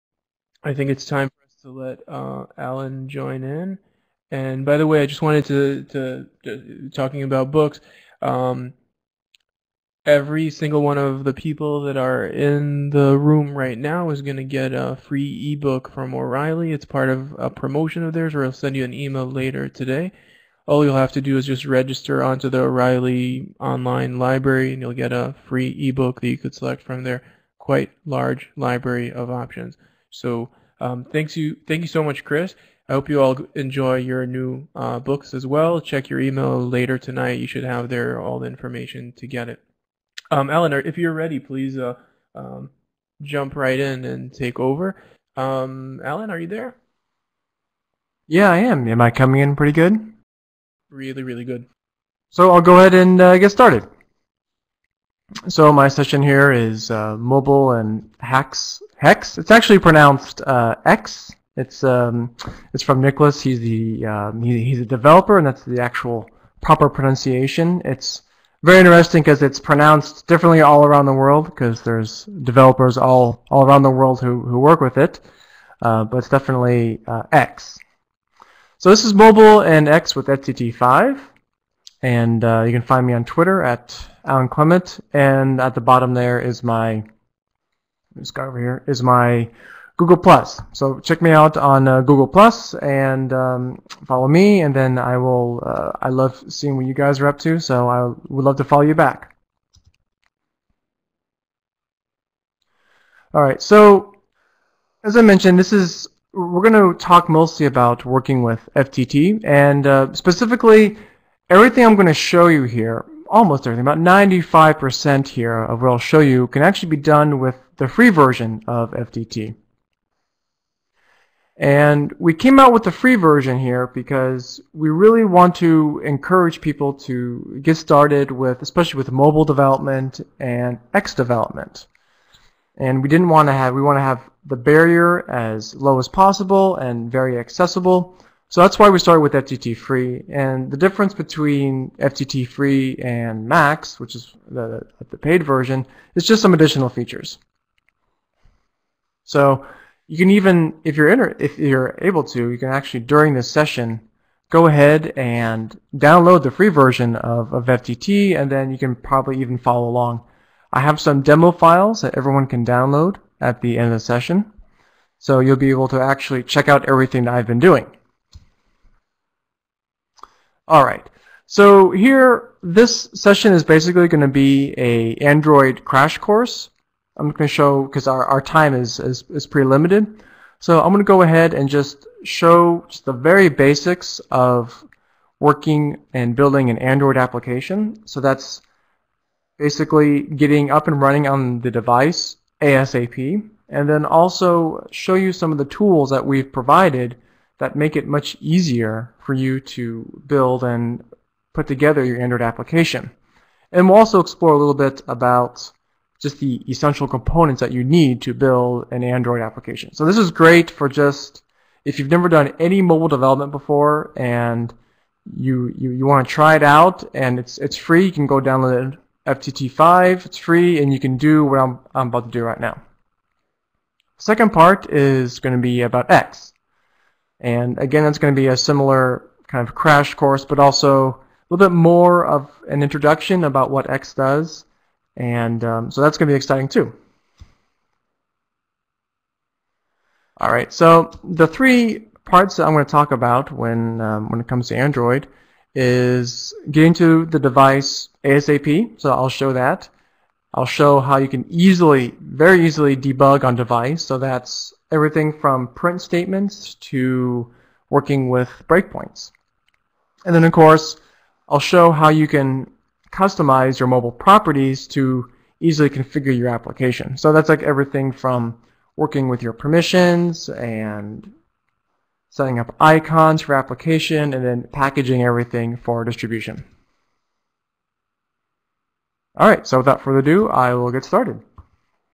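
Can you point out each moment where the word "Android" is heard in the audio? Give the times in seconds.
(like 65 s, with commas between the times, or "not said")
175 s, 186 s, 202 s, 209 s, 244 s.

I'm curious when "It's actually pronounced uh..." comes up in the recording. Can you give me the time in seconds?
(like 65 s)
59 s.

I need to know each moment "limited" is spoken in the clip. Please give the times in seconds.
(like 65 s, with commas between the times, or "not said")
179 s.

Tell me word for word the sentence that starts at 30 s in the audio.
So um, thanks you, thank you so much, Chris.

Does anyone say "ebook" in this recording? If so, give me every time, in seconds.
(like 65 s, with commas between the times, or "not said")
15 s, 25 s.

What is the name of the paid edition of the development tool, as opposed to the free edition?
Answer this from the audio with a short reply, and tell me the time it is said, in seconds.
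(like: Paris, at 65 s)
Max, at 143 s.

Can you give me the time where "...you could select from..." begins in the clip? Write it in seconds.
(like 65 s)
26 s.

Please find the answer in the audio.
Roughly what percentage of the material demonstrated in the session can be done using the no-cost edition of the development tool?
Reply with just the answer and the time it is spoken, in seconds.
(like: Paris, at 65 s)
95%, at 113 s.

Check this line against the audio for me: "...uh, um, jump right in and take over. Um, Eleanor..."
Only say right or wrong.
wrong.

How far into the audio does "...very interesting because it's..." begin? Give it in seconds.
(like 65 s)
68 s.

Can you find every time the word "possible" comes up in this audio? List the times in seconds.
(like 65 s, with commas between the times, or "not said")
136 s.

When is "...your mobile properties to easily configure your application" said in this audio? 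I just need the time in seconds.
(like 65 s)
263 s.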